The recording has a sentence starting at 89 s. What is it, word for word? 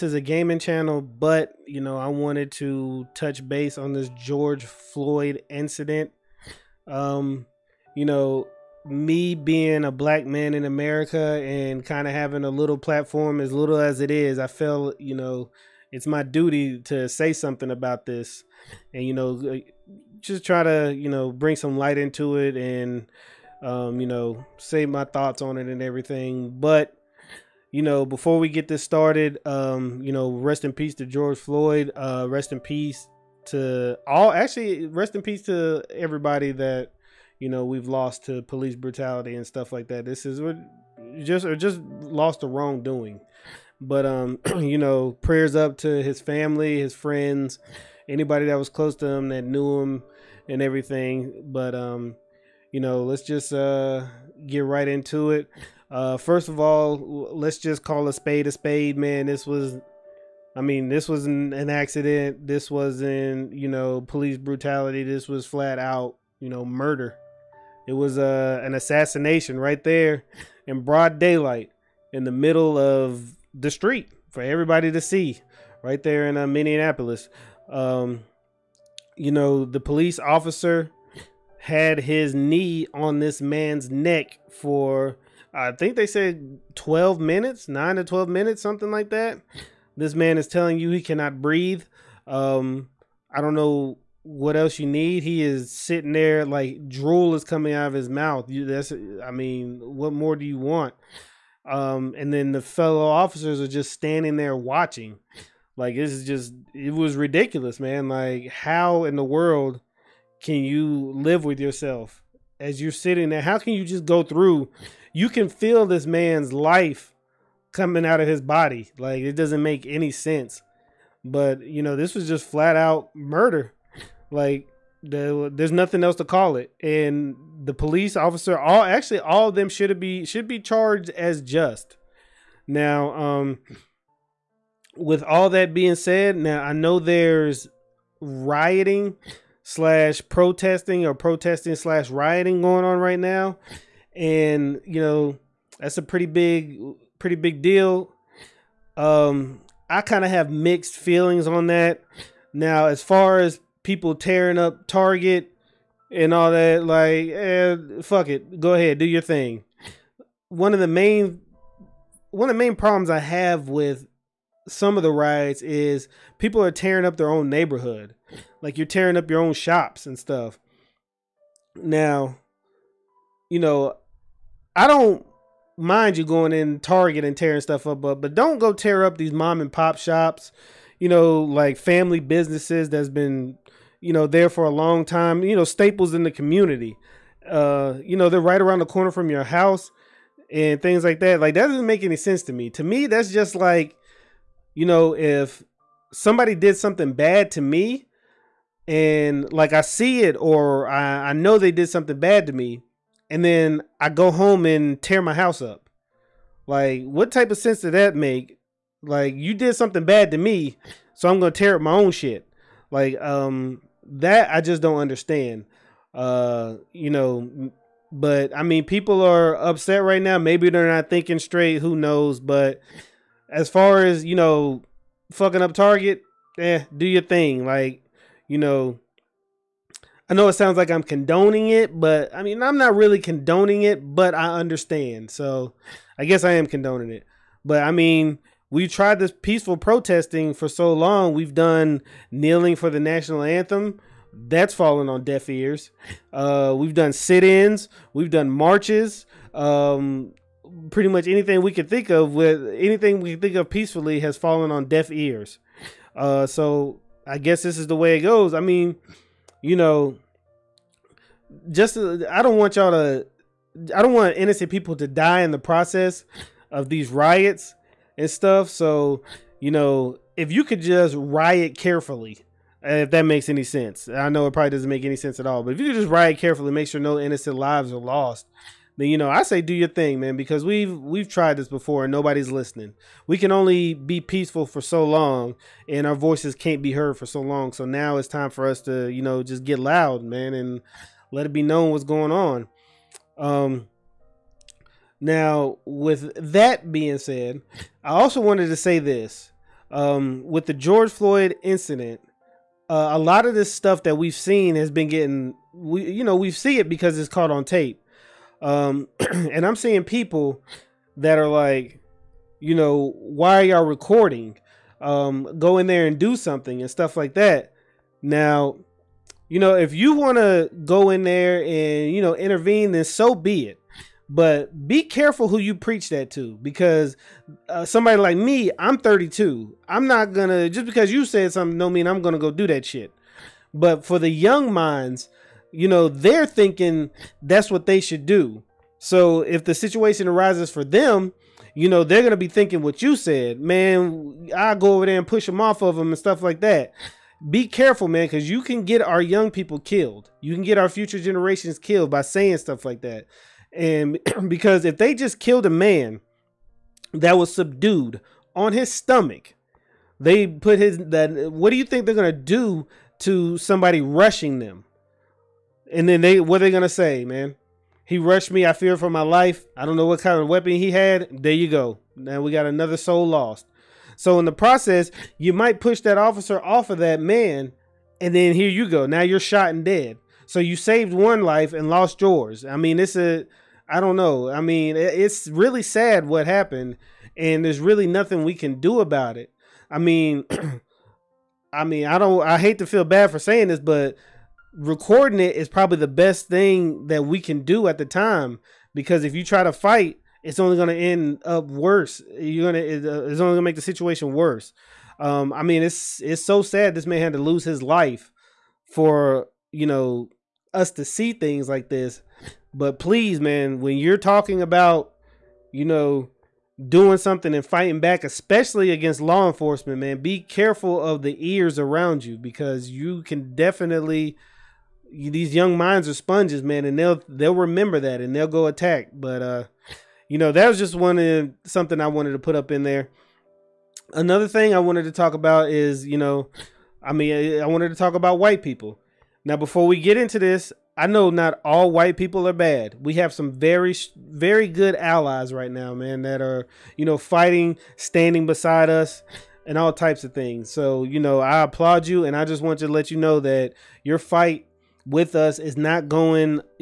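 This man is telling you he cannot breathe.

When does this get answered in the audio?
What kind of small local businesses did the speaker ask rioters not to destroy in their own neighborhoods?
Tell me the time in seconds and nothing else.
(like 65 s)
179 s.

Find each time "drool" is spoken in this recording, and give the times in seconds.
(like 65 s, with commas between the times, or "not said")
96 s.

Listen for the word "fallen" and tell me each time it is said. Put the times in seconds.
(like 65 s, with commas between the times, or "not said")
244 s, 254 s.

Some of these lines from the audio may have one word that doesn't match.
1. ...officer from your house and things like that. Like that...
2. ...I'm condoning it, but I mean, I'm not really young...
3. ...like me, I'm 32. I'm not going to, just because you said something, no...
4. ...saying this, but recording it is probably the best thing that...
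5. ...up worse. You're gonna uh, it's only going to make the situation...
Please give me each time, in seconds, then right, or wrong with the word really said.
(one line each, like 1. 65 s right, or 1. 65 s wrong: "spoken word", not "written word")
1. 188 s wrong: "corner", not "officer"
2. 230 s wrong: "condoning", not "young"
3. 328 s right
4. 393 s right
5. 401 s right.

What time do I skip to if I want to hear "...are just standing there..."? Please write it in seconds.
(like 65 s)
103 s.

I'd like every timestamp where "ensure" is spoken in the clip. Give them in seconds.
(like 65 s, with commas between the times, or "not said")
not said.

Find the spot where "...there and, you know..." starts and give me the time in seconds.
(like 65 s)
321 s.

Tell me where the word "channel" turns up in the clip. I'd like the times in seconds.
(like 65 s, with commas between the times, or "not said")
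0 s.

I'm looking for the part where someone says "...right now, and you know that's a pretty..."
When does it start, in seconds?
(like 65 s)
142 s.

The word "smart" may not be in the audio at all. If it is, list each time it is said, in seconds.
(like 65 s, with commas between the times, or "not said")
not said.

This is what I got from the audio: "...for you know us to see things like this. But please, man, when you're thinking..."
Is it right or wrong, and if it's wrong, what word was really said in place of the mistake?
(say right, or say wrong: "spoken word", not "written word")
wrong: "talking", not "thinking".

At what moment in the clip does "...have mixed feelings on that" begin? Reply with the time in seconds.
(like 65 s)
150 s.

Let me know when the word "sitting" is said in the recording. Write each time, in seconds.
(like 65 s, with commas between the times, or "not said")
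95 s, 112 s.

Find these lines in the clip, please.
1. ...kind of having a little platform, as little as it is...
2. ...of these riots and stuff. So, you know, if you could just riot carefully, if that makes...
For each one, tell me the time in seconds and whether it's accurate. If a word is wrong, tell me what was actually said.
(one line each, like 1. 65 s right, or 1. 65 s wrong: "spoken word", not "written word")
1. 11 s right
2. 266 s right.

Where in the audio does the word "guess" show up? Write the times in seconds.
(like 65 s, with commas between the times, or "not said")
236 s, 257 s.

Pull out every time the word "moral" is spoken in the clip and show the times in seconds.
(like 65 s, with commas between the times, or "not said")
not said.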